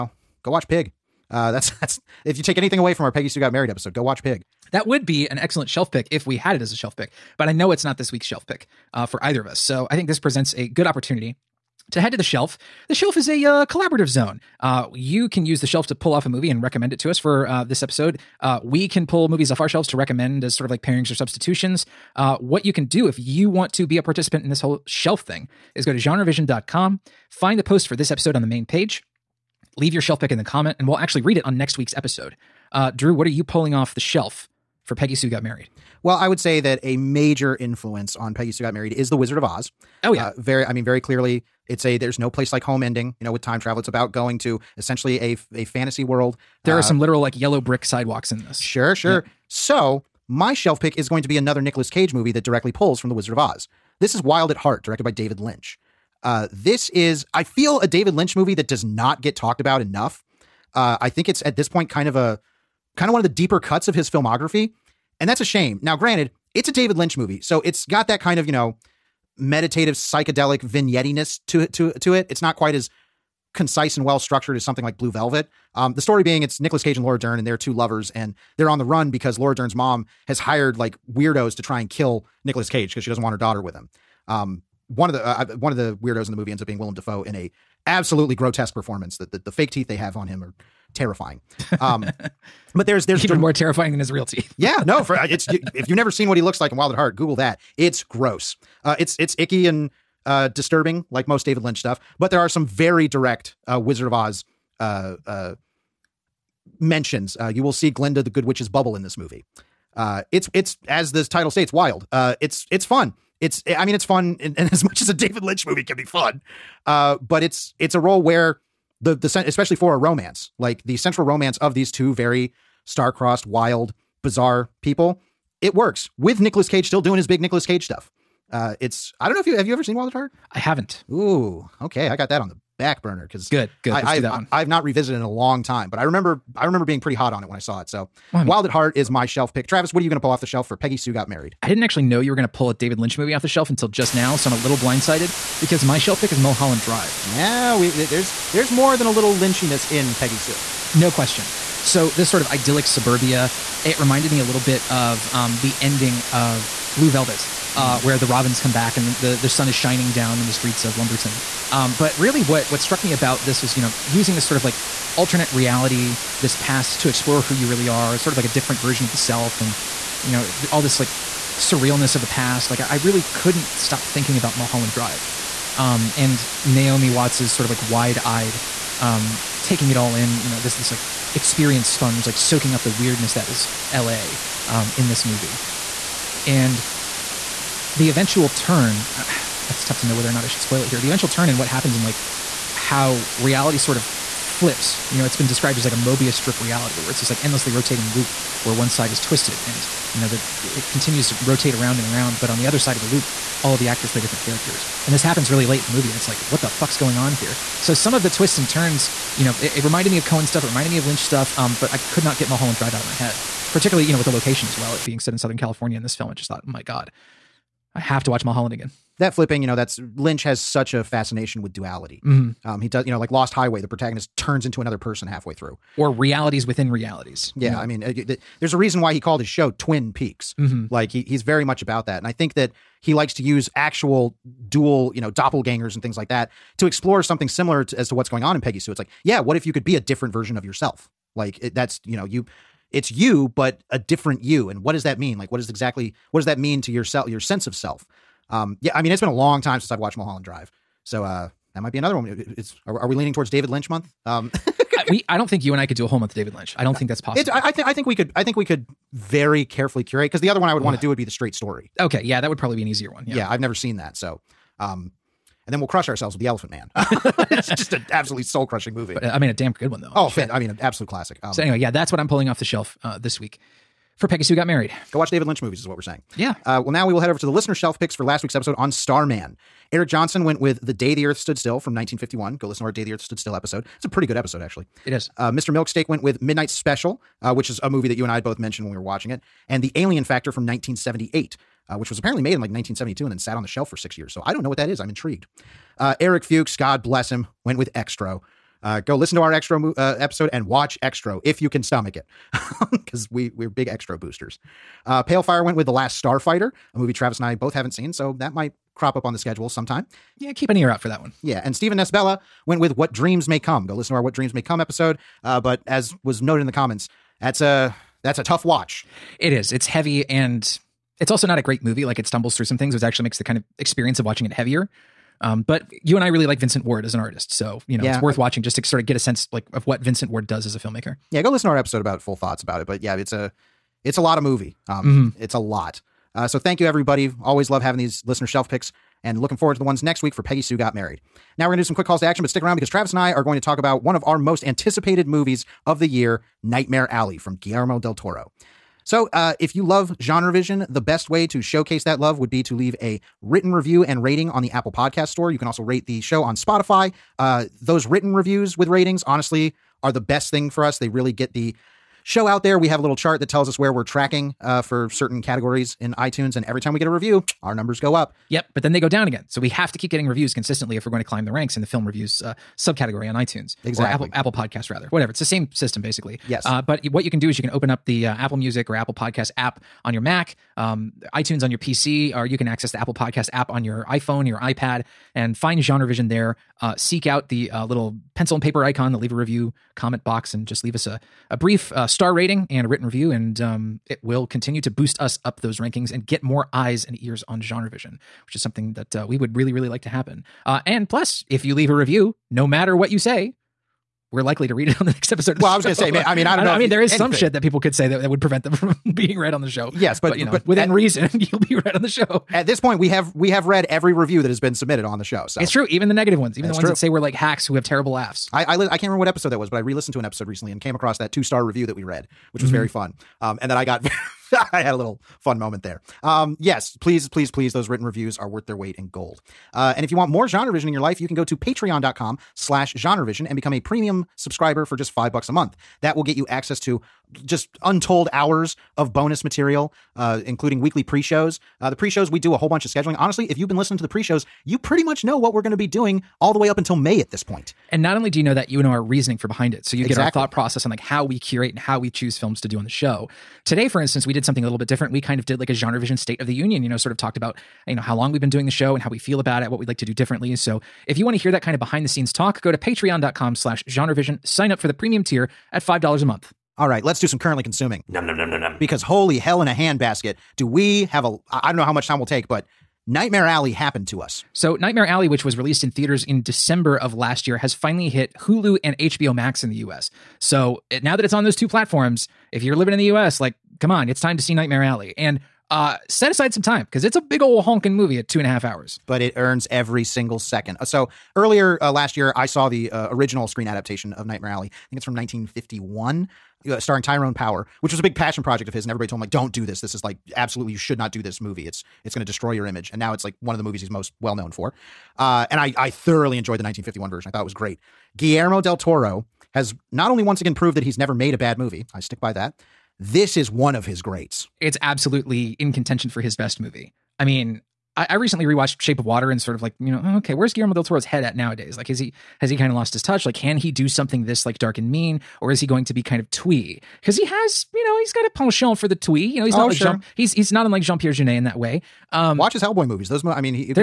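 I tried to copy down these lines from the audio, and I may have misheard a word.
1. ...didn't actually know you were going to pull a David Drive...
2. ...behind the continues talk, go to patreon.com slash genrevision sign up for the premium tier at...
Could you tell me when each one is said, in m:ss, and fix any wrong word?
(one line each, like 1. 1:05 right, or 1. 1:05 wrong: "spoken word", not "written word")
1. 2:21 wrong: "Lynch", not "Drive"
2. 7:41 wrong: "scenes", not "continues".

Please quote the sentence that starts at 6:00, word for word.
They really get the show out there.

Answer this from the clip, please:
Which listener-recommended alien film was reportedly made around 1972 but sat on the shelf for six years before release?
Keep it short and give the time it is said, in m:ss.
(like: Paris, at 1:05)
The Alien Factor, at 4:49.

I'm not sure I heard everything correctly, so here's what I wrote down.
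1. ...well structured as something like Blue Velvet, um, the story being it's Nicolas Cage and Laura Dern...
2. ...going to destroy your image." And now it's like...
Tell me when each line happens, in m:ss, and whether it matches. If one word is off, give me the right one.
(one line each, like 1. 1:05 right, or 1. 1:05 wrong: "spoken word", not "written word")
1. 1:14 right
2. 8:22 right.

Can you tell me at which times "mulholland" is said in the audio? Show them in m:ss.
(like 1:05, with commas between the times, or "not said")
2:26, 2:54, 3:32, 3:38, 4:10.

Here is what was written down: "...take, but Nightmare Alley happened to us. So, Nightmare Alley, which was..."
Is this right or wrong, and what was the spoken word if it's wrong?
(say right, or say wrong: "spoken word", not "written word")
right.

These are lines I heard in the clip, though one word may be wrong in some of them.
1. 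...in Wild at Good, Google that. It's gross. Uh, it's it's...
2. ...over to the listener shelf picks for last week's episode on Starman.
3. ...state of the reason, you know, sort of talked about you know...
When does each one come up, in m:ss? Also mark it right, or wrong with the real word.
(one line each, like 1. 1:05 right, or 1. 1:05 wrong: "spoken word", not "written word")
1. 1:36 wrong: "Heart", not "Good"
2. 4:37 right
3. 7:36 wrong: "union", not "reason".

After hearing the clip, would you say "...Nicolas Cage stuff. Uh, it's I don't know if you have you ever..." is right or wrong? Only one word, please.
right.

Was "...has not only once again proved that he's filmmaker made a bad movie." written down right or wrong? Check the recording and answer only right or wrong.
wrong.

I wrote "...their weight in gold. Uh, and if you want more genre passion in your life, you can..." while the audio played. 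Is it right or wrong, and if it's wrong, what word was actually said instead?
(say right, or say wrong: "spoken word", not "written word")
wrong: "vision", not "passion".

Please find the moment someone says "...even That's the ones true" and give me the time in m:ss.
6:56.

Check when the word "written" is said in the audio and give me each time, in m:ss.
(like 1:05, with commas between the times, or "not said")
5:53, 5:58, 6:32, 7:07.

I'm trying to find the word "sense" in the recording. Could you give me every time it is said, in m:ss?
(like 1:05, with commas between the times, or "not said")
4:07, 5:29.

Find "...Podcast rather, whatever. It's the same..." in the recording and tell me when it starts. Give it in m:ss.
6:14.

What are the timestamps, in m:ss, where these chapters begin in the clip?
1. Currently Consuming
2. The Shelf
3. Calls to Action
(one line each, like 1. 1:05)
1. 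7:46
2. 0:12
3. 5:48.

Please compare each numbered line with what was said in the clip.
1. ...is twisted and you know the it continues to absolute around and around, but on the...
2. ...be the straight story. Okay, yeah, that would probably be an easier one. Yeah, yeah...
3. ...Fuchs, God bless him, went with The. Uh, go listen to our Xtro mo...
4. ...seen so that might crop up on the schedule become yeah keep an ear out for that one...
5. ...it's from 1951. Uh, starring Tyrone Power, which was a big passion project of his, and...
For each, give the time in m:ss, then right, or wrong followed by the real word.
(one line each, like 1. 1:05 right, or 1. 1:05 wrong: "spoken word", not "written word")
1. 3:19 wrong: "rotate", not "absolute"
2. 4:21 right
3. 4:56 wrong: "Xtro", not "The"
4. 5:07 wrong: "sometime", not "become"
5. 8:14 right.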